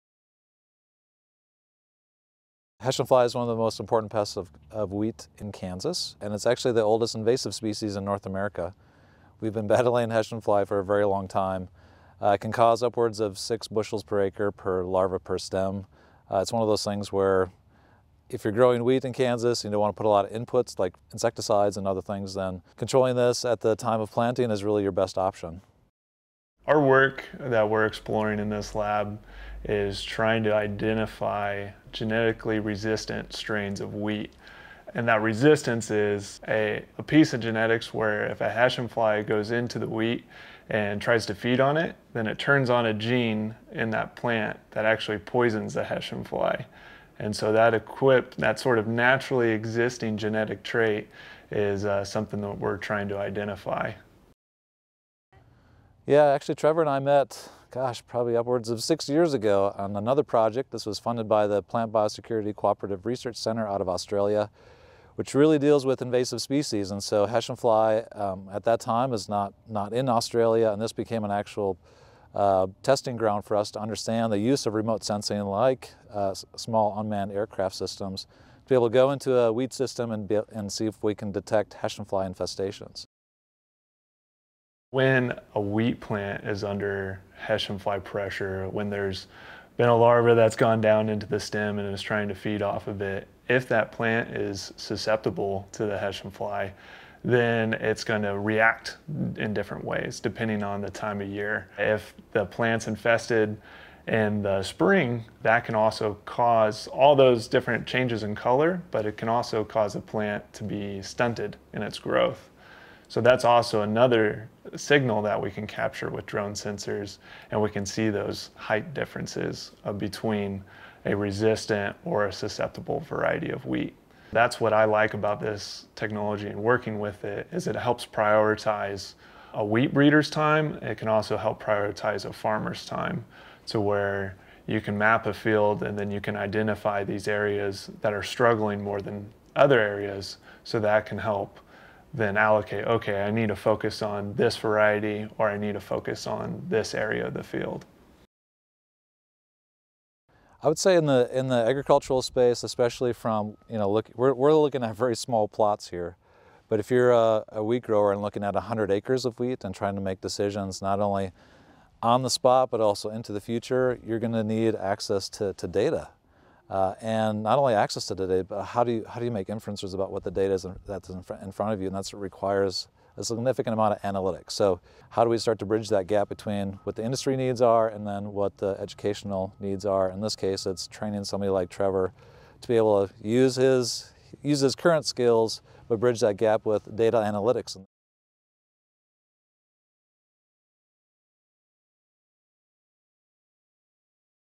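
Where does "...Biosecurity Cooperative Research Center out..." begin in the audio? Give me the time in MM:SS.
01:01.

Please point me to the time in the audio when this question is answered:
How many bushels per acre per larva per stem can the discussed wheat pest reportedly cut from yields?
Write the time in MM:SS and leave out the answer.
00:13.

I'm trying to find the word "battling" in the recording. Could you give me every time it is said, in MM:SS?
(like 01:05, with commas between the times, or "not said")
00:09.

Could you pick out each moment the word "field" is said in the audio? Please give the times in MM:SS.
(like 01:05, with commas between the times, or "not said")
02:15, 02:27.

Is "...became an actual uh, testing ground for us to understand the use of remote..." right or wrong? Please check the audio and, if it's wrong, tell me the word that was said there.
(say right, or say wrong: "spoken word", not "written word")
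right.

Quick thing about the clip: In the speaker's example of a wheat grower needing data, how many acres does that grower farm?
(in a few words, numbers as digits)
100.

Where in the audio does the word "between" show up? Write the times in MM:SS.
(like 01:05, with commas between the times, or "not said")
01:59, 02:56.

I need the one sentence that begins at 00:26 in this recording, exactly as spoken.
Our work that we're exploring in this lab is trying to identify genetically resistant strains of wheat.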